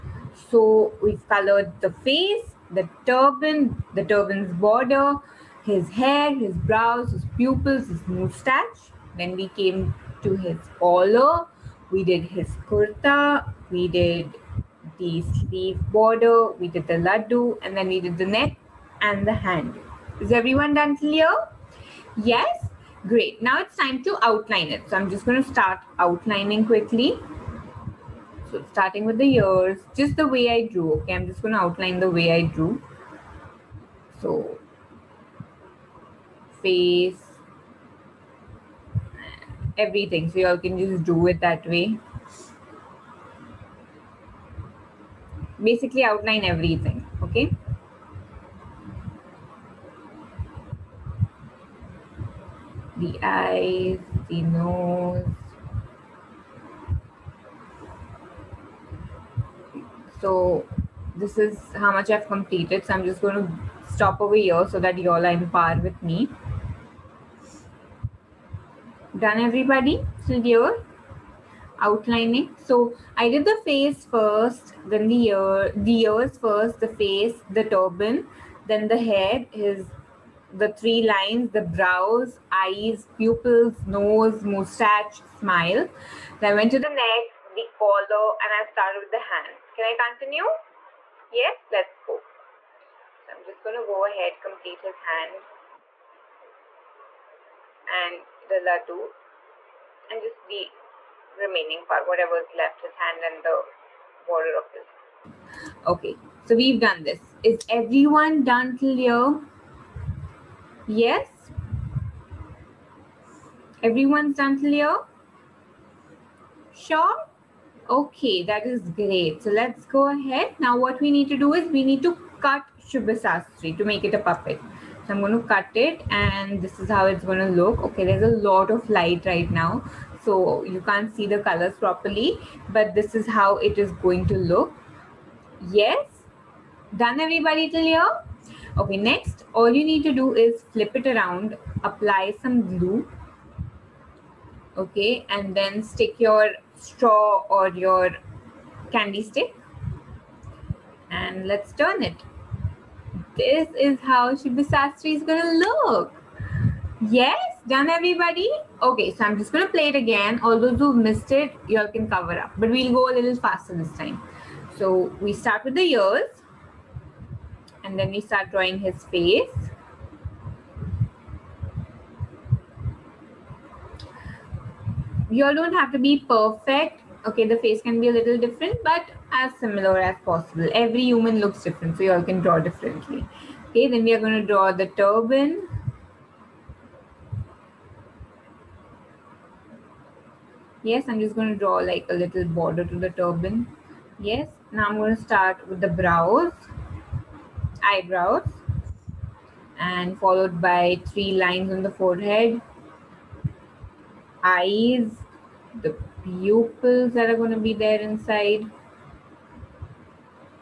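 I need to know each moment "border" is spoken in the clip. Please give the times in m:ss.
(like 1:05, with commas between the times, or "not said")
0:04, 0:15, 1:44, 3:12.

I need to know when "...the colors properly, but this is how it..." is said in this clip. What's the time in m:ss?
2:11.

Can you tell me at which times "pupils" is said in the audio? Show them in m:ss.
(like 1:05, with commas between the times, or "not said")
0:07, 1:23, 3:26.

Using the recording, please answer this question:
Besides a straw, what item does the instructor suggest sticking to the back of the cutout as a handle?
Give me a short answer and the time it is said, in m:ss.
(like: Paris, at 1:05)
candy stick, at 2:28.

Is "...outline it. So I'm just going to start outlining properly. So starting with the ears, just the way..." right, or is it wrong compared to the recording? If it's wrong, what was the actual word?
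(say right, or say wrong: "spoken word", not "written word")
wrong: "quickly", not "properly".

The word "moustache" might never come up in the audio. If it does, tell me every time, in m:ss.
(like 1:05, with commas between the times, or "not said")
0:08.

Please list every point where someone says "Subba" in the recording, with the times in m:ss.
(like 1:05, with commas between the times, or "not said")
2:02, 2:34.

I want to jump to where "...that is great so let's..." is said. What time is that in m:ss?
1:58.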